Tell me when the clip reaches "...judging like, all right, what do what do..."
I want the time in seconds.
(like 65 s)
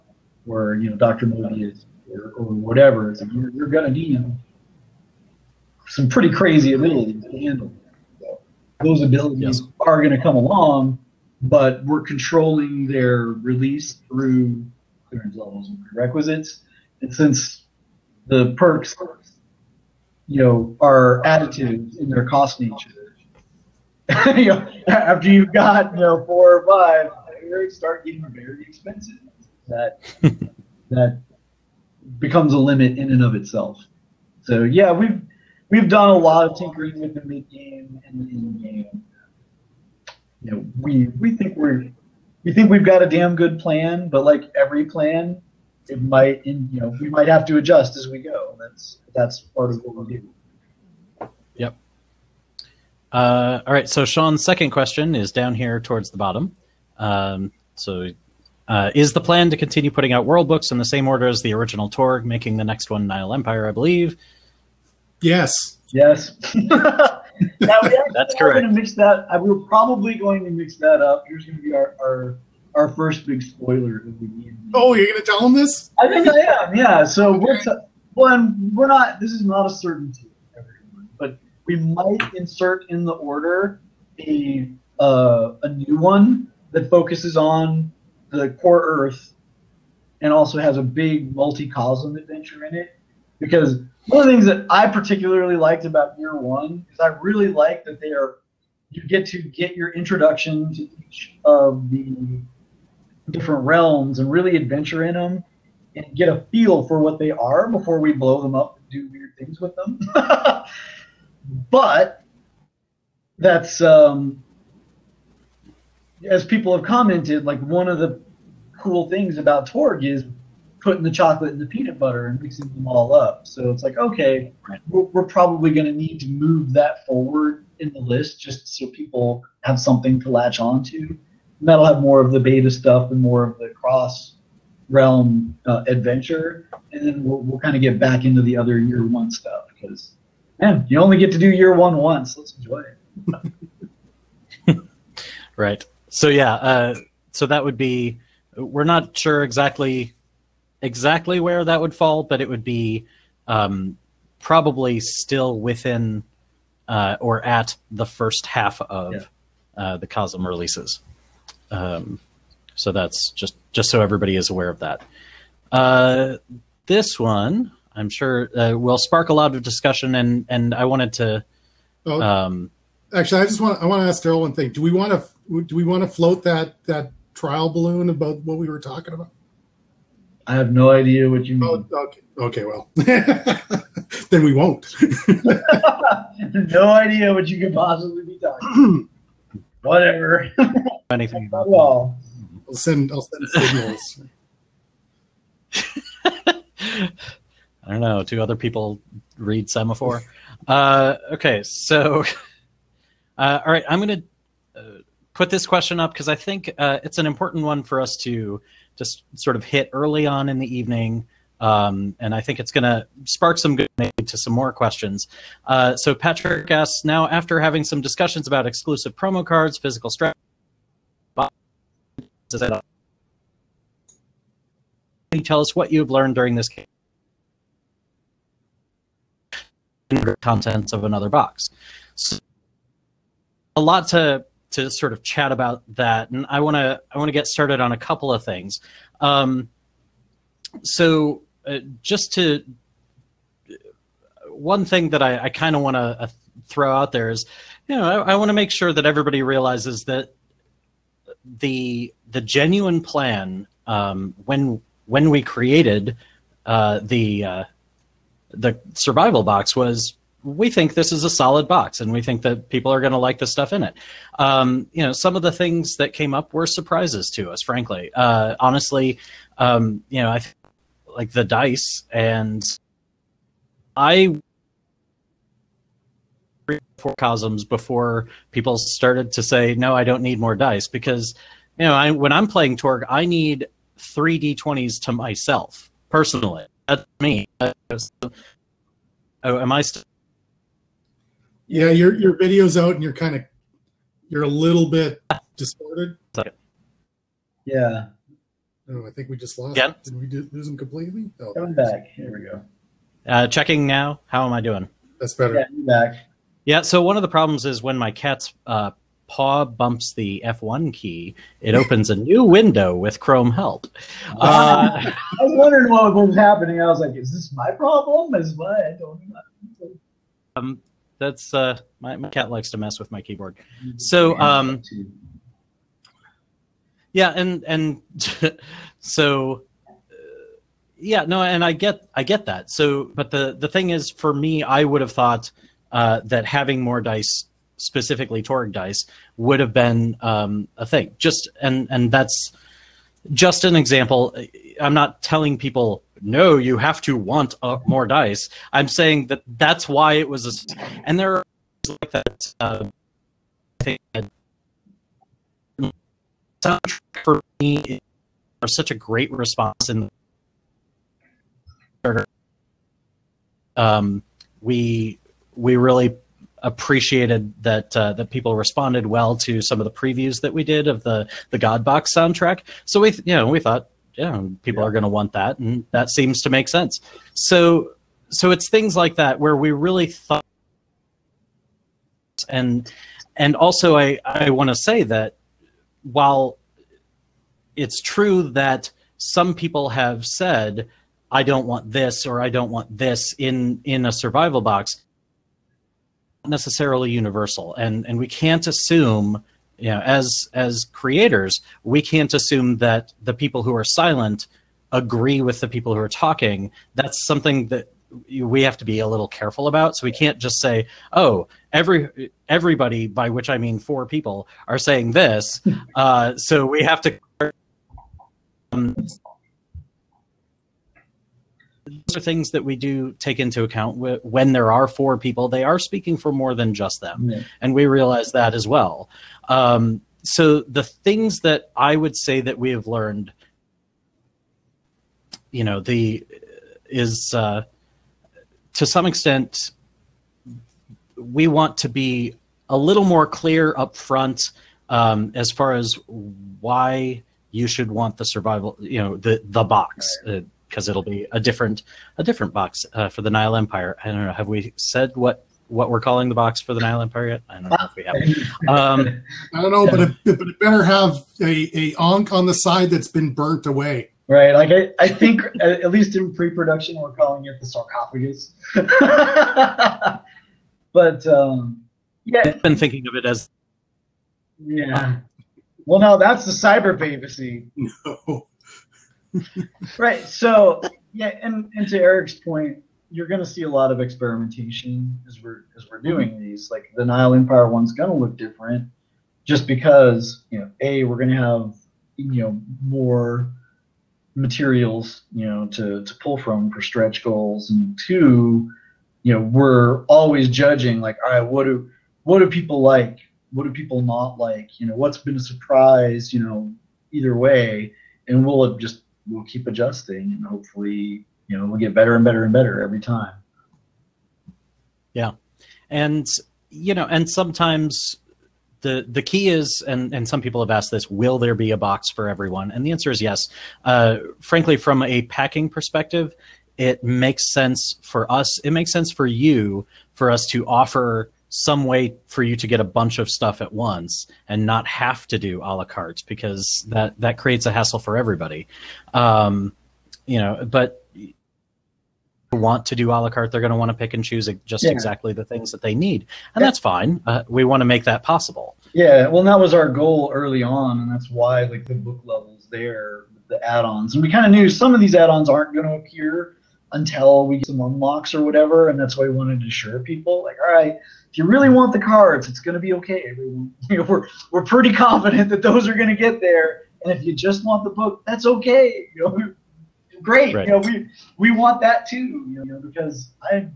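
500 s.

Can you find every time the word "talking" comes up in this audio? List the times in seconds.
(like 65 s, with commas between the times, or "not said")
178 s, 188 s, 406 s.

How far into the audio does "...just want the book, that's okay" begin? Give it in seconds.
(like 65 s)
567 s.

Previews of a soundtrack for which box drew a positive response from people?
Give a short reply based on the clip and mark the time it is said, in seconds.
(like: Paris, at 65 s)
God Box, at 371 s.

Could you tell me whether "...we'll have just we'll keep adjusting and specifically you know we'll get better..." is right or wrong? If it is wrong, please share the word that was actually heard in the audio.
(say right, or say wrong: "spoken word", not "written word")
wrong: "hopefully", not "specifically".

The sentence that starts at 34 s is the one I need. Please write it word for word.
So yeah, we've we've done a lot of tinkering with the mid game and end game.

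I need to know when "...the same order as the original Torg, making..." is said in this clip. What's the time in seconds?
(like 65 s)
60 s.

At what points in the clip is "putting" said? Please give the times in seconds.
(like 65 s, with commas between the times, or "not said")
59 s, 120 s.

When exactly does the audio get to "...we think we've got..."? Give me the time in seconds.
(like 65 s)
42 s.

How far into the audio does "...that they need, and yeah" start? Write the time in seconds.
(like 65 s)
545 s.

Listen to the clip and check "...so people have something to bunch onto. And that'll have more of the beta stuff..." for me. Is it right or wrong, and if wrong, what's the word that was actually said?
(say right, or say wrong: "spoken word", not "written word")
wrong: "latch", not "bunch".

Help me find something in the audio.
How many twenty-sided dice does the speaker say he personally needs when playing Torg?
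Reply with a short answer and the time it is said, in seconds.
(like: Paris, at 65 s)
3, at 283 s.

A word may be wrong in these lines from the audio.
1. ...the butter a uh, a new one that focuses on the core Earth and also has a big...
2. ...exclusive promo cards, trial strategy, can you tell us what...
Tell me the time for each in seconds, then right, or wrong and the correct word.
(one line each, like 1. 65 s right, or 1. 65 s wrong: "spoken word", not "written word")
1. 83 s wrong: "order", not "butter"
2. 218 s wrong: "physical", not "trial".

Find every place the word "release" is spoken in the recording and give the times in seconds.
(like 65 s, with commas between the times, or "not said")
13 s, 160 s.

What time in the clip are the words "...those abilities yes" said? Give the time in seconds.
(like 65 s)
8 s.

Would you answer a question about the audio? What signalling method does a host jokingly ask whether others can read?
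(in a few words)
semaphore.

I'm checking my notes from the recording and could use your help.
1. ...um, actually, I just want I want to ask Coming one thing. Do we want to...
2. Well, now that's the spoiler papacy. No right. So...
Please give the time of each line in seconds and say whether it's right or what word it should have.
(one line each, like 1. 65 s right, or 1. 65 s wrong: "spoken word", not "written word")
1. 172 s wrong: "Darrell", not "Coming"
2. 475 s wrong: "cyber", not "spoiler".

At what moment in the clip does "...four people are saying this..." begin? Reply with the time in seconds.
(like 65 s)
413 s.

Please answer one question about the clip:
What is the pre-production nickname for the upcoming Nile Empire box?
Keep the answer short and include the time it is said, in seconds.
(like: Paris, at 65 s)
the sarcophagus, at 467 s.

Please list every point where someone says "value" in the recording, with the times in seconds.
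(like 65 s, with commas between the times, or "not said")
not said.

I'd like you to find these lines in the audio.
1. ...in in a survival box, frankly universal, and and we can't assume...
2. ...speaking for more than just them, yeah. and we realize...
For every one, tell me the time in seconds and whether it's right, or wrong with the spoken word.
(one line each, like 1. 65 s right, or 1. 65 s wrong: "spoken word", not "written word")
1. 393 s wrong: "necessarily", not "frankly"
2. 425 s right.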